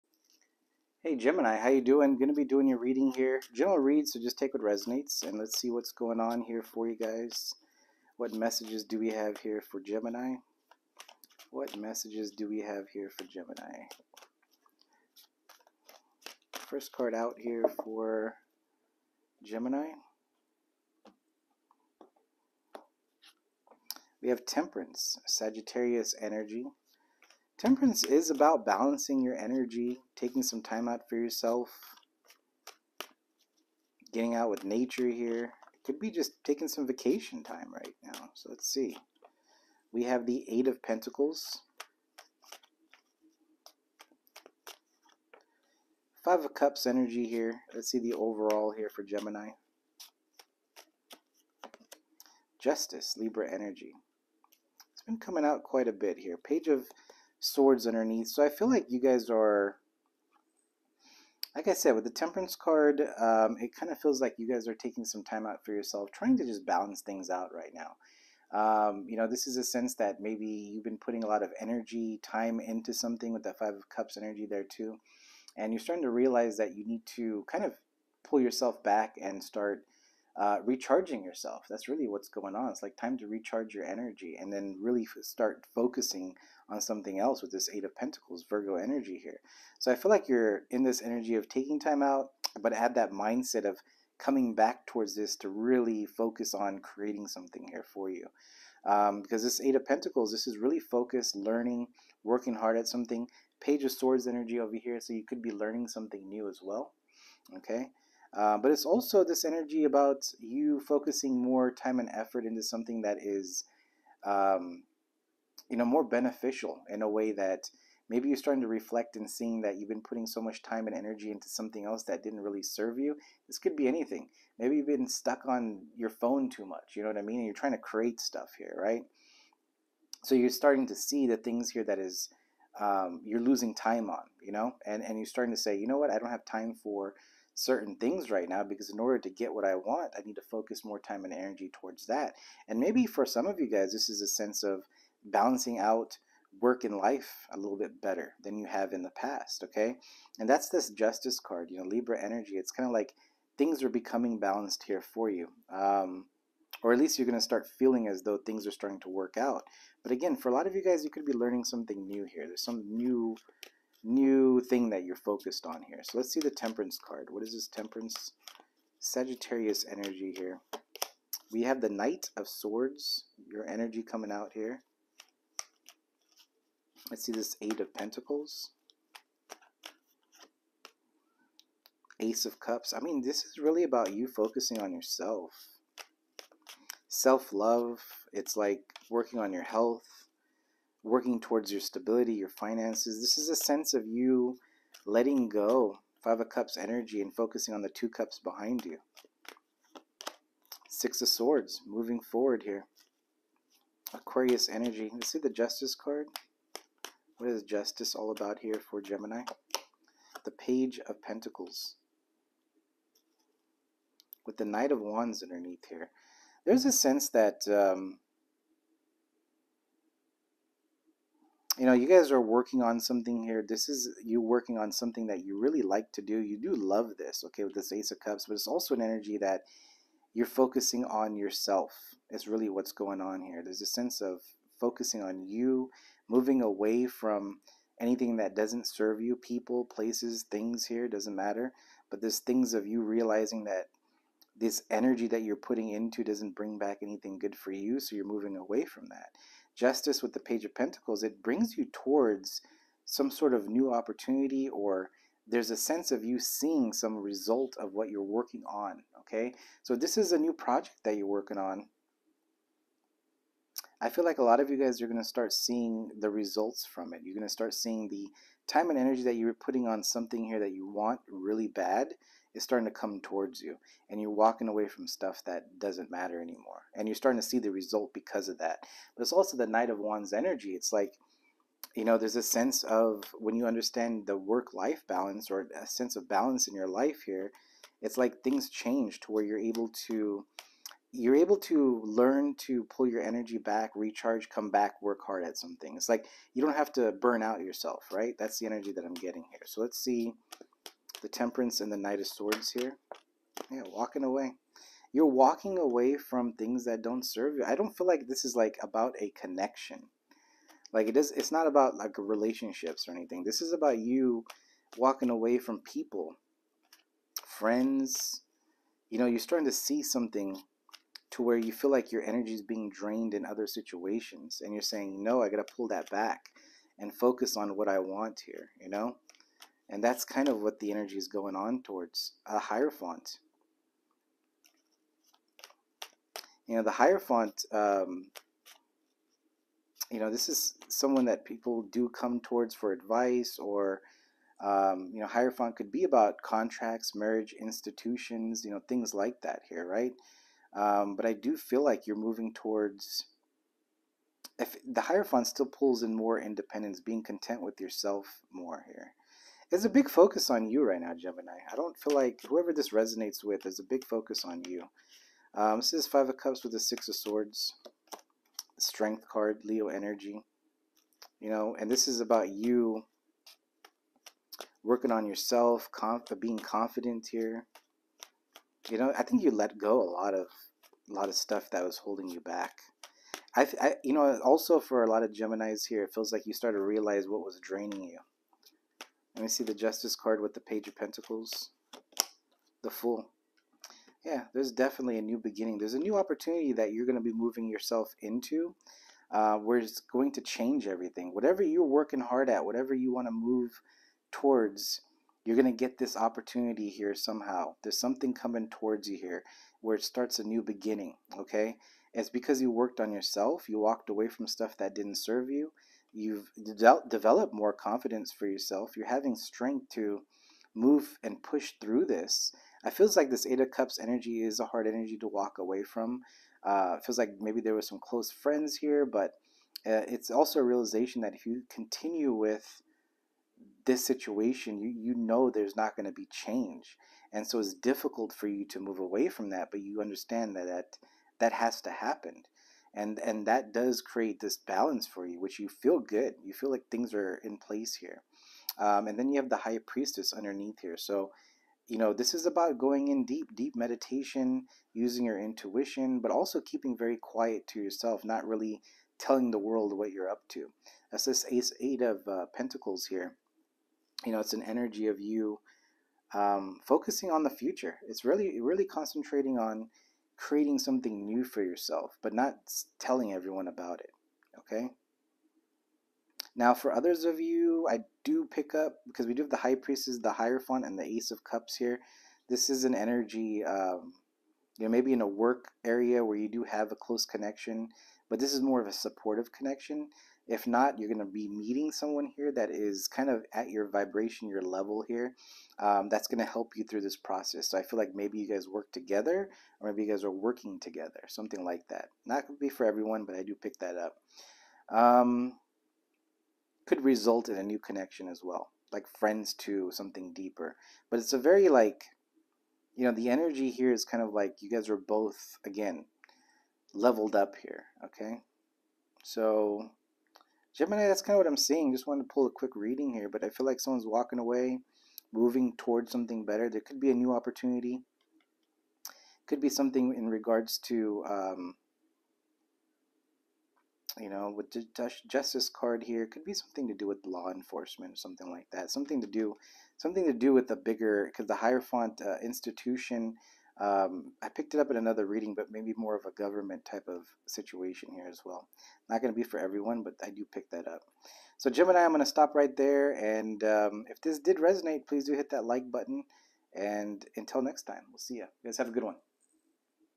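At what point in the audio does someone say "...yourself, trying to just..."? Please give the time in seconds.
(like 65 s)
65 s.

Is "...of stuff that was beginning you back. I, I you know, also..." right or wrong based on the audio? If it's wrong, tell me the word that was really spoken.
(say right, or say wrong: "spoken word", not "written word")
wrong: "holding", not "beginning".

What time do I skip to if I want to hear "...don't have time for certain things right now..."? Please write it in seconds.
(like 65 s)
136 s.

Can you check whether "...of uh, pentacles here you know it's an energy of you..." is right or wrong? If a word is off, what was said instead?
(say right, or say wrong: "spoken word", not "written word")
right.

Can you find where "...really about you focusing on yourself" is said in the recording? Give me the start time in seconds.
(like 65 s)
183 s.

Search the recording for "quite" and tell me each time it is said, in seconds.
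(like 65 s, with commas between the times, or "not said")
55 s.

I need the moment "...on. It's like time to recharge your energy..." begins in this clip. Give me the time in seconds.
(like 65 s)
82 s.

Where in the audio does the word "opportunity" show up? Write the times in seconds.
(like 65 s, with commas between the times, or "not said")
253 s, 396 s, 406 s, 527 s.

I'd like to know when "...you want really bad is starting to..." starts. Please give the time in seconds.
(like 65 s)
270 s.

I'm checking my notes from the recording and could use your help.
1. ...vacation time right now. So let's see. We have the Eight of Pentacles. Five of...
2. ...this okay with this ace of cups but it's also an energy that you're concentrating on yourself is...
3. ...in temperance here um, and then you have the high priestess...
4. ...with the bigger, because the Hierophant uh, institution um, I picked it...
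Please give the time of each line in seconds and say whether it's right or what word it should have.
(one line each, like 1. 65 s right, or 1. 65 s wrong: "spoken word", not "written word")
1. 36 s right
2. 227 s wrong: "focusing", not "concentrating"
3. 447 s wrong: "place", not "temperance"
4. 540 s right.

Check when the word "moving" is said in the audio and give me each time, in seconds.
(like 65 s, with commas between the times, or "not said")
201 s, 236 s, 248 s, 352 s, 397 s, 525 s.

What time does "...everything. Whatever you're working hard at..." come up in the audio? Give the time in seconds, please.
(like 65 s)
400 s.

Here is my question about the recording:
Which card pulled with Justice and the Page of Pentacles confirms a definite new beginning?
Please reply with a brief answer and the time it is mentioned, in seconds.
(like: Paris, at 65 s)
The Fool, at 392 s.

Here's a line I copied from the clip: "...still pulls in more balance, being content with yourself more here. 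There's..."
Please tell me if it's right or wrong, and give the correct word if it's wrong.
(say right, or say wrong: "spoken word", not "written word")
wrong: "independence", not "balance".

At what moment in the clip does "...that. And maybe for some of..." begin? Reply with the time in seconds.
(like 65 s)
142 s.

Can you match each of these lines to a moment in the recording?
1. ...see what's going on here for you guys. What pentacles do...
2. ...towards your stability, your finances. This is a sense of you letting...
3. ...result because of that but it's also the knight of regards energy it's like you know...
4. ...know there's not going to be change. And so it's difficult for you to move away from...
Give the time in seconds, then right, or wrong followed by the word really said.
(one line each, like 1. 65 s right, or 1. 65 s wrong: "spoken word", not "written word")
1. 5 s wrong: "messages", not "pentacles"
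2. 191 s right
3. 277 s wrong: "wands", not "regards"
4. 435 s right.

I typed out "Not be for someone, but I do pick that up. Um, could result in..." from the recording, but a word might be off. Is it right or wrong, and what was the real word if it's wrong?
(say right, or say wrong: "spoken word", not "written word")
wrong: "everyone", not "someone".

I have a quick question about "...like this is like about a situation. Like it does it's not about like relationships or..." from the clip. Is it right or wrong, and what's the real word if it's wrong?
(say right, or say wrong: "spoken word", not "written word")
wrong: "connection", not "situation".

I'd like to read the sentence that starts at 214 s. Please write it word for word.
With the Knight of Wands underneath here.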